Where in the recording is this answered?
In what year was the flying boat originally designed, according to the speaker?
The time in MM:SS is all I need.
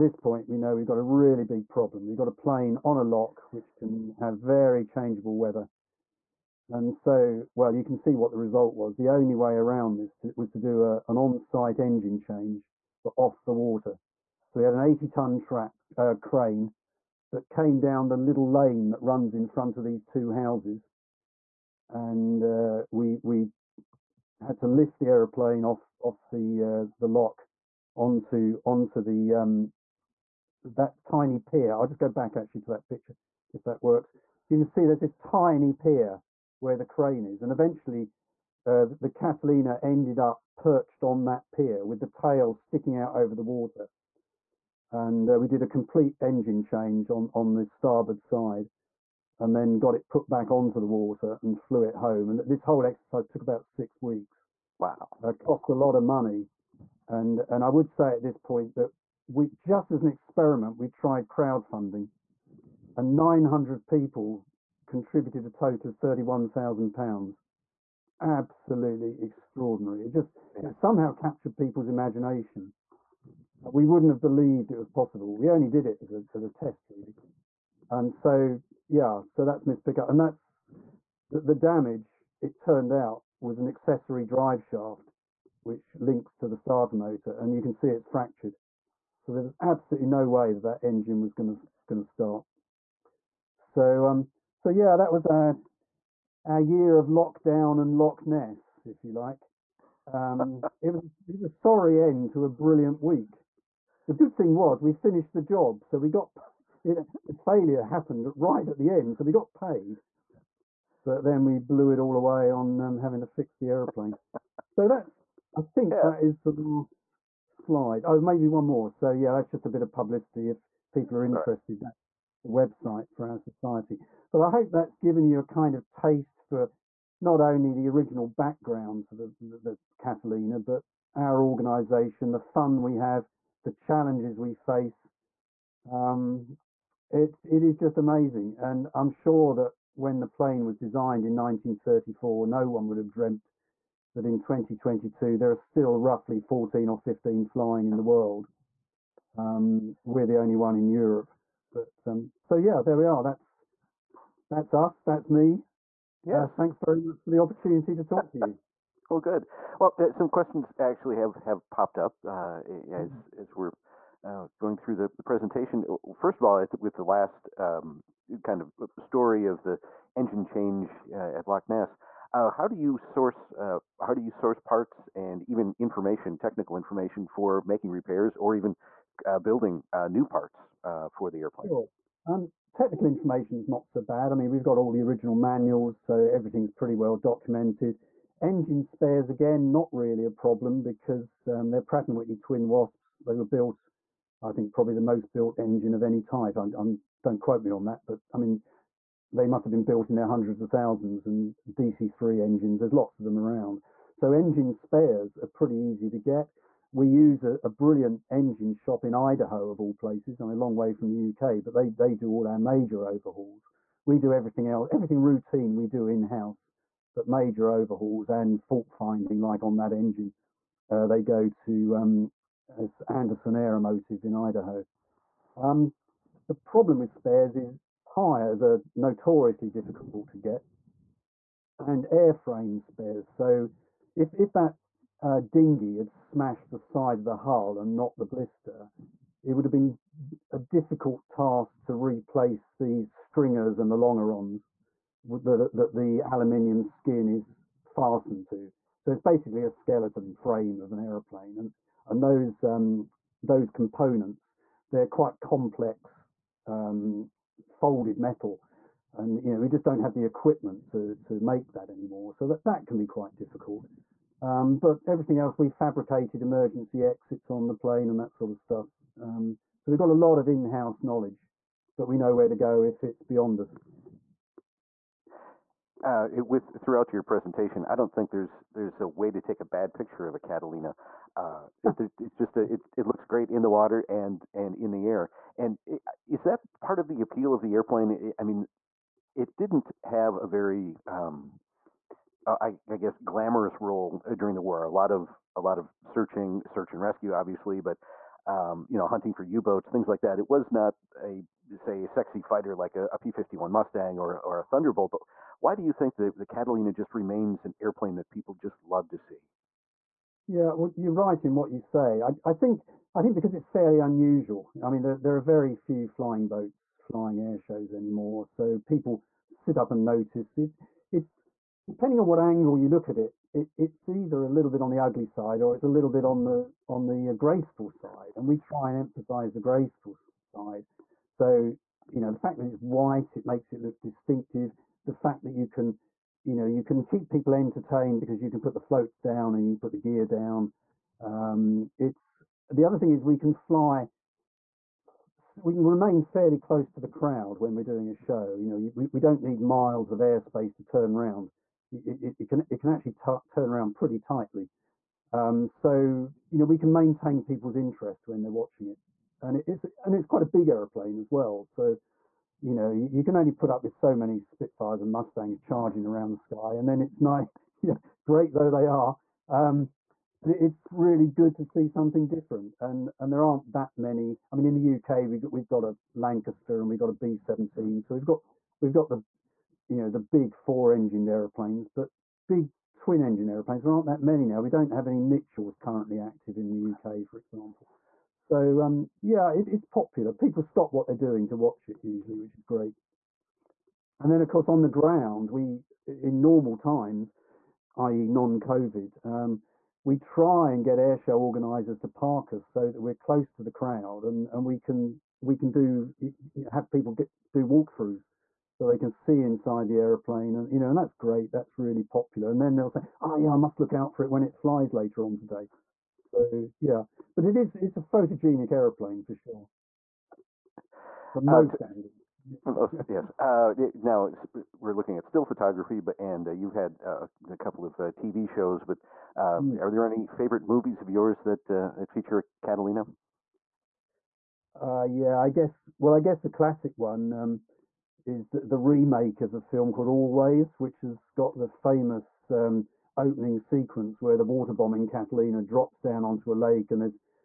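02:21.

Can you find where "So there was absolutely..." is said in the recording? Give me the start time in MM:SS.
01:29.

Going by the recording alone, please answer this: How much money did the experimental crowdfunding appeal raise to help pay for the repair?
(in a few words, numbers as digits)
£31,000.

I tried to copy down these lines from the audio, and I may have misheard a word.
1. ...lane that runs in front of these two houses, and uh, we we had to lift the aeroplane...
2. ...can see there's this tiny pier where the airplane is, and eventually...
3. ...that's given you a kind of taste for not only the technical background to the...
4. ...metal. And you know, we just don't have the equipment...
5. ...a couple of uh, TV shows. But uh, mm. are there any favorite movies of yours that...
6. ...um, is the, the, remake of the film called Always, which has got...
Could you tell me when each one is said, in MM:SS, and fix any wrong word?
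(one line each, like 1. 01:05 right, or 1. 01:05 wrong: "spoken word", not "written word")
1. 00:18 right
2. 00:34 wrong: "crane", not "airplane"
3. 02:04 wrong: "original", not "technical"
4. 04:18 right
5. 07:07 right
6. 07:17 right.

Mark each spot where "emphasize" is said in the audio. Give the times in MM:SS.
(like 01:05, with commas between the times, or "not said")
05:29.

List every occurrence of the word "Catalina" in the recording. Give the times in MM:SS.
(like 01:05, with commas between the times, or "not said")
00:39, 02:09, 04:40, 05:06, 07:12, 07:25.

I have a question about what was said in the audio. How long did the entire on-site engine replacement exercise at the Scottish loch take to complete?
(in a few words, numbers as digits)
six weeks.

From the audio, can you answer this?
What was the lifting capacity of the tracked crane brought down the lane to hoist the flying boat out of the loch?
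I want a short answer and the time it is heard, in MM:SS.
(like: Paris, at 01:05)
80 tons, at 00:14.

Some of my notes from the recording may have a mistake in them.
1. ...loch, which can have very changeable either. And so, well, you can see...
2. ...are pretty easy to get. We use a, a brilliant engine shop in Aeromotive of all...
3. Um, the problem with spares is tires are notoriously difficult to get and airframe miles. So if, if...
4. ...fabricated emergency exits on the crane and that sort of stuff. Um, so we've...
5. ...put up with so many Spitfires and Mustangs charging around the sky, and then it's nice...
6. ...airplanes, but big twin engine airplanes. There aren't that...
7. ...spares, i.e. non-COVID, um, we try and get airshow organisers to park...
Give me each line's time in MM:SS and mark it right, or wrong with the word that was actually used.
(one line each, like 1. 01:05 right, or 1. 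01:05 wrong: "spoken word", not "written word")
1. 00:03 wrong: "weather", not "either"
2. 03:25 wrong: "Idaho", not "Aeromotive"
3. 03:45 wrong: "spares", not "miles"
4. 04:25 wrong: "plane", not "crane"
5. 06:03 right
6. 06:21 right
7. 06:36 wrong: "times", not "spares".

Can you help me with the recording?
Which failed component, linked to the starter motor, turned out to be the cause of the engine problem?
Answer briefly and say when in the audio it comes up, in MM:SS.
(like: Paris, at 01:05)
accessory drive shaft, at 01:23.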